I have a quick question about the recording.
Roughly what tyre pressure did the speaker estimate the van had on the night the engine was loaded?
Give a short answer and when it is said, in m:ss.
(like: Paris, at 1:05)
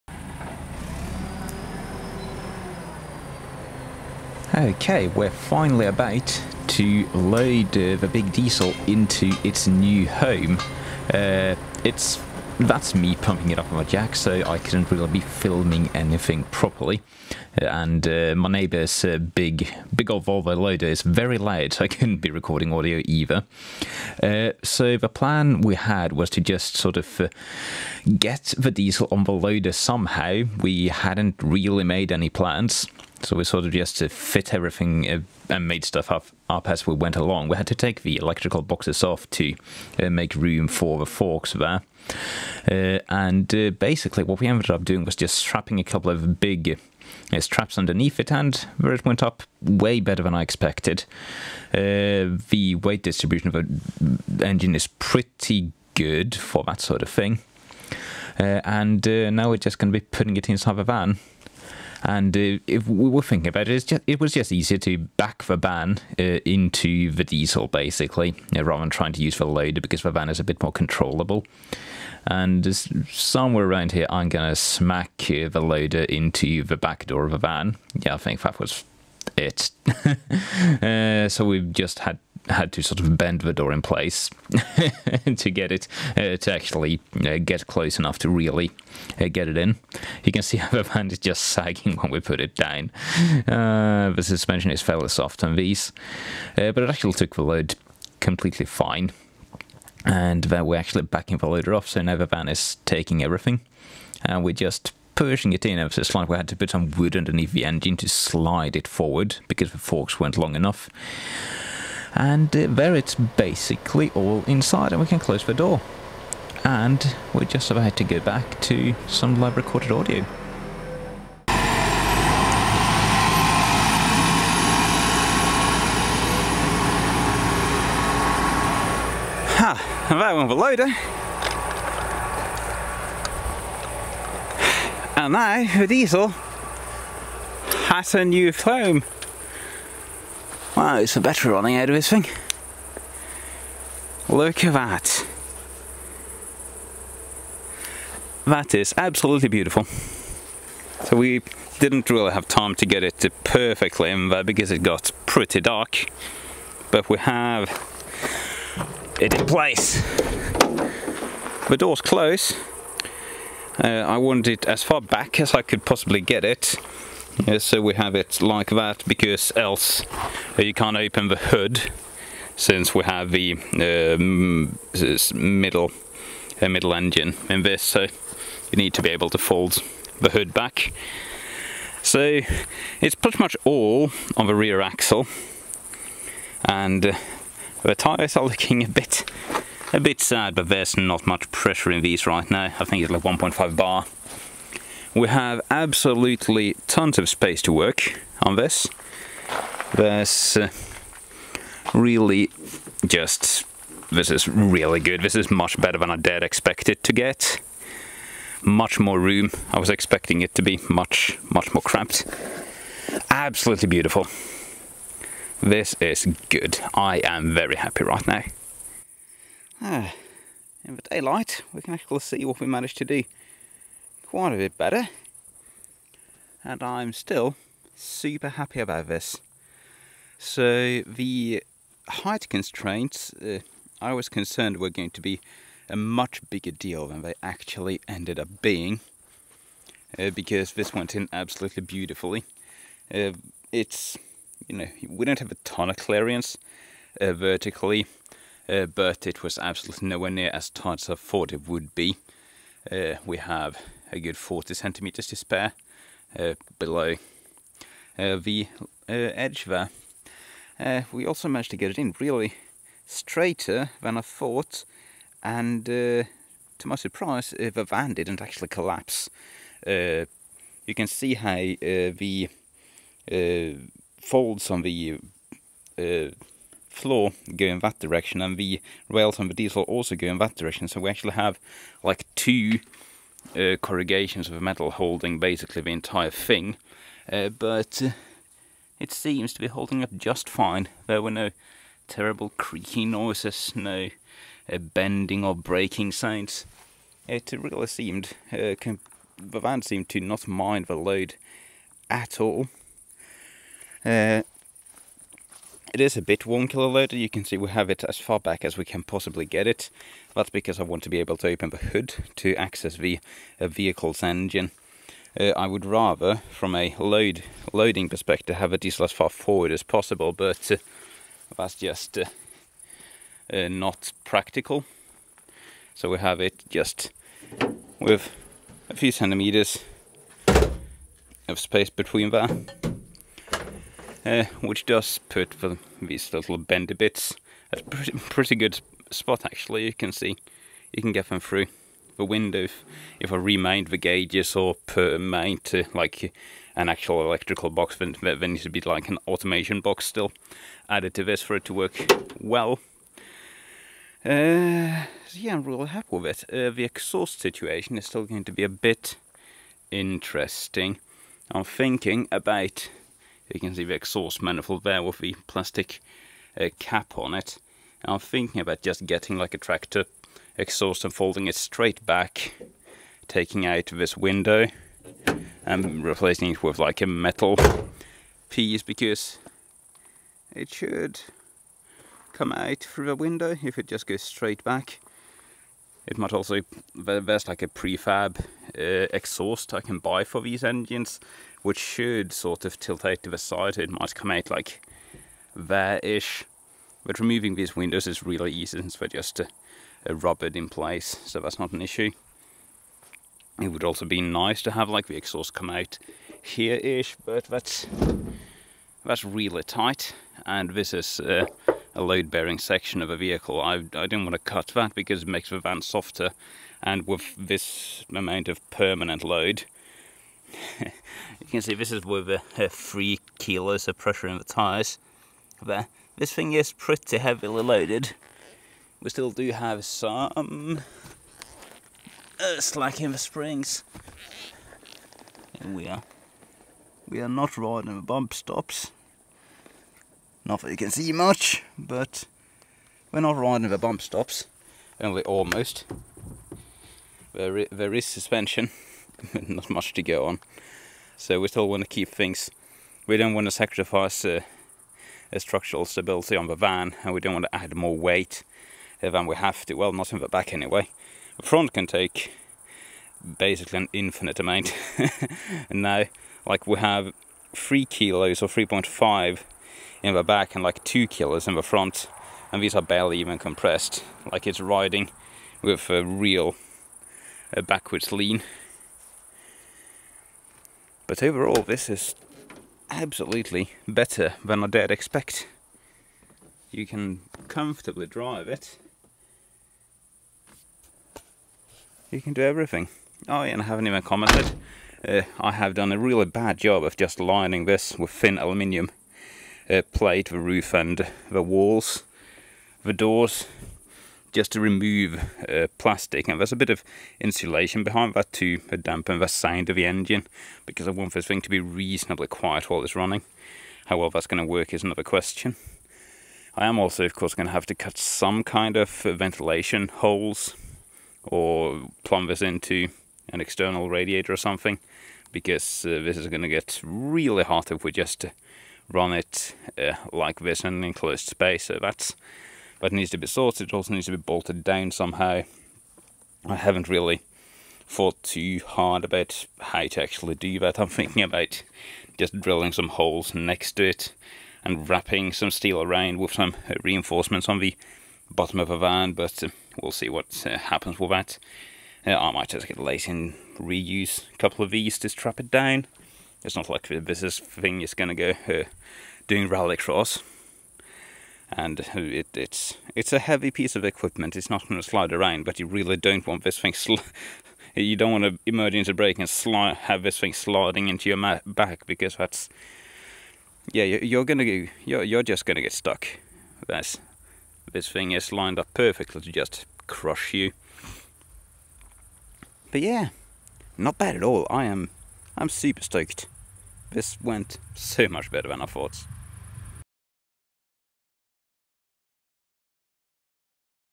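1.5 bar, at 3:13.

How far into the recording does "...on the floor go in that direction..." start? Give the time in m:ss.
4:34.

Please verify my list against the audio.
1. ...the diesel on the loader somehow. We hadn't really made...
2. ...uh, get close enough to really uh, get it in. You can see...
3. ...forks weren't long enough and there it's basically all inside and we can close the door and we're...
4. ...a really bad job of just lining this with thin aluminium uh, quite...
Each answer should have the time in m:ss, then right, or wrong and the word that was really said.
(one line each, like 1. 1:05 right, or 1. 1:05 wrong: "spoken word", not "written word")
1. 0:28 right
2. 1:27 right
3. 1:49 right
4. 8:15 wrong: "plate", not "quite".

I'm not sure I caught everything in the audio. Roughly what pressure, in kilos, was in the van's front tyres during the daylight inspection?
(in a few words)
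2.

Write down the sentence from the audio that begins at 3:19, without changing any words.
There's uh, really just, this is really good.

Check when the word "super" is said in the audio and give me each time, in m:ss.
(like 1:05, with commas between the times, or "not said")
3:47, 9:45.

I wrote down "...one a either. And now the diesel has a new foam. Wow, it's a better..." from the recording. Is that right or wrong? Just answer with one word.
wrong.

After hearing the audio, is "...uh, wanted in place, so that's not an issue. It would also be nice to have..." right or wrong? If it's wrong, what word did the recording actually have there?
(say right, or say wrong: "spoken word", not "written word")
wrong: "rubbered", not "wanted".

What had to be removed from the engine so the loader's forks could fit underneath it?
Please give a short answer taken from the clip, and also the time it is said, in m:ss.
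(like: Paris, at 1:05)
electrical boxes, at 0:38.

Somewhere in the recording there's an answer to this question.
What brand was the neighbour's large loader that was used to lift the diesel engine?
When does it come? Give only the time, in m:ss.
0:20.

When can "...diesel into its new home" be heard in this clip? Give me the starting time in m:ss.
0:08.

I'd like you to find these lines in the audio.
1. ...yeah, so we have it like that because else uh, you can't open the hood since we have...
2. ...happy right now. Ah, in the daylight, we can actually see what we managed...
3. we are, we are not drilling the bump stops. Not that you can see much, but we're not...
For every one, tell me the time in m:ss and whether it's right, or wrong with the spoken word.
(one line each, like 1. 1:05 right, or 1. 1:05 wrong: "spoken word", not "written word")
1. 2:47 right
2. 3:37 right
3. 7:15 wrong: "riding", not "drilling".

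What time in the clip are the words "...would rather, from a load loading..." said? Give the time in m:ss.
5:15.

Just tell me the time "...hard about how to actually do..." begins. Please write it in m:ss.
8:58.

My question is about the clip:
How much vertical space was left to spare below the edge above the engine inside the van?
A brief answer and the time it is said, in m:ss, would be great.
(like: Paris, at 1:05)
40 centimeters, at 4:14.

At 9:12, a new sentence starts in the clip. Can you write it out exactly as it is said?
Uh, I might just get lazy and reuse a couple of these to strap it down.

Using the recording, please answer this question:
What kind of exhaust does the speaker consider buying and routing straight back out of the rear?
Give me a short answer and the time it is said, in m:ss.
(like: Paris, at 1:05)
tractor exhaust, at 6:09.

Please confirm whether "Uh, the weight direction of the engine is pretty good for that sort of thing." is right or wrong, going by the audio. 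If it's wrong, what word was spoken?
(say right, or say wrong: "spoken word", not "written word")
wrong: "distribution", not "direction".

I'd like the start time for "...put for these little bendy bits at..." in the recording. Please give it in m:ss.
5:35.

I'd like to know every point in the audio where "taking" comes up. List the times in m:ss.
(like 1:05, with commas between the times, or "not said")
1:42, 6:13.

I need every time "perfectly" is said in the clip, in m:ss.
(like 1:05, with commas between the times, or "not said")
2:33, 9:38.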